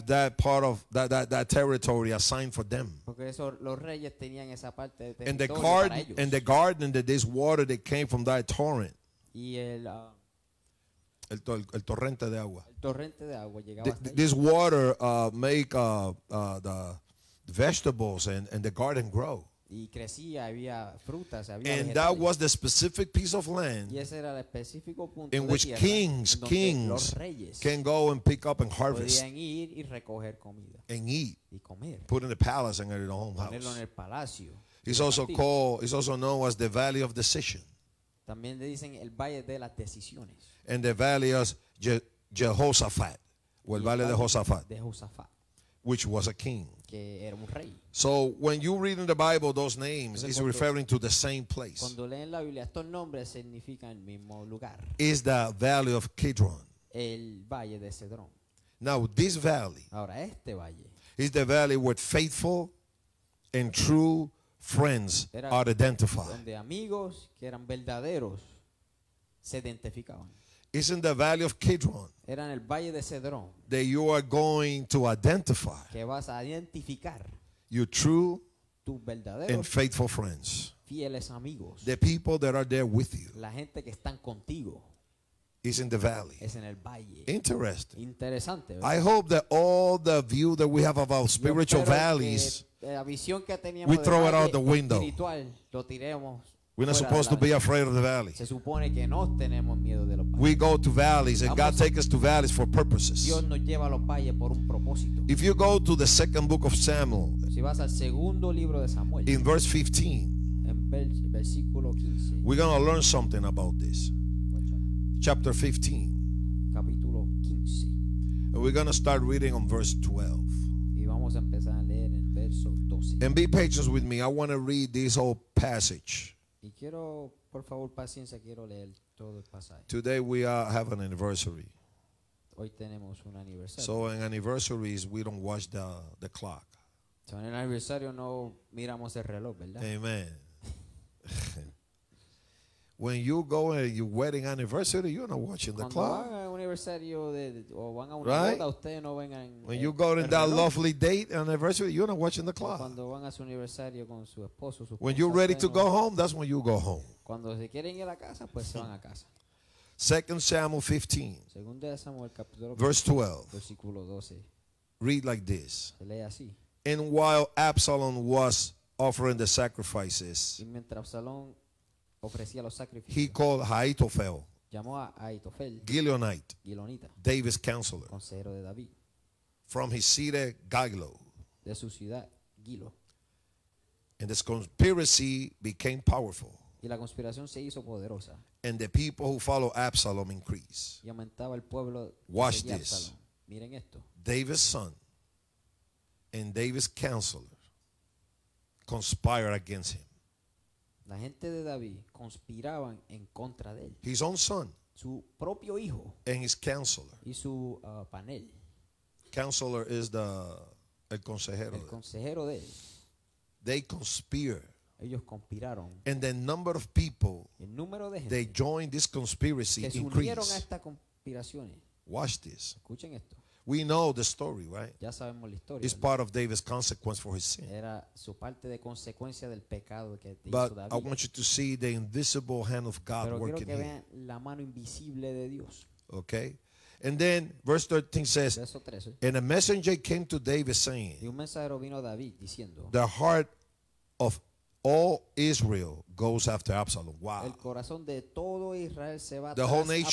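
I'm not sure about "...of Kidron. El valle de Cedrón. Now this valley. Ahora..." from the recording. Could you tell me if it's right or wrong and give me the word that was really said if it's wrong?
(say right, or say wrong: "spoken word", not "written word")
right.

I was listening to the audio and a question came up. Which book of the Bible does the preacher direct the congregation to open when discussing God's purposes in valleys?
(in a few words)
Second Samuel.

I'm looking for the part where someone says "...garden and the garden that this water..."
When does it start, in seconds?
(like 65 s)
5 s.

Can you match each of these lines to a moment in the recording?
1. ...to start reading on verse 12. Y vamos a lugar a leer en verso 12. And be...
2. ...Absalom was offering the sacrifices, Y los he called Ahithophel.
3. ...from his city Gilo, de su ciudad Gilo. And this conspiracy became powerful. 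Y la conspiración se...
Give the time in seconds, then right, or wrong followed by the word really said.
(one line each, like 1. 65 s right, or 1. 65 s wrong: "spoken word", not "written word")
1. 118 s wrong: "empezar", not "lugar"
2. 167 s right
3. 179 s right.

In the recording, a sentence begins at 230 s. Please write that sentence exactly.
I want you to see the invisible hand of God Pero quiero working que here.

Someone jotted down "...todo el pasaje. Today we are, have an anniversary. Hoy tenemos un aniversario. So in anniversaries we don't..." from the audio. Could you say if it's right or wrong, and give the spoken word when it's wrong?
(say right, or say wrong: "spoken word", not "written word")
right.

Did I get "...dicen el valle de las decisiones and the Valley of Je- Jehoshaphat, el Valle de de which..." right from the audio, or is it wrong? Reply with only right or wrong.
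right.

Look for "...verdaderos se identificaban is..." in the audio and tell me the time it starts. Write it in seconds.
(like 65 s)
67 s.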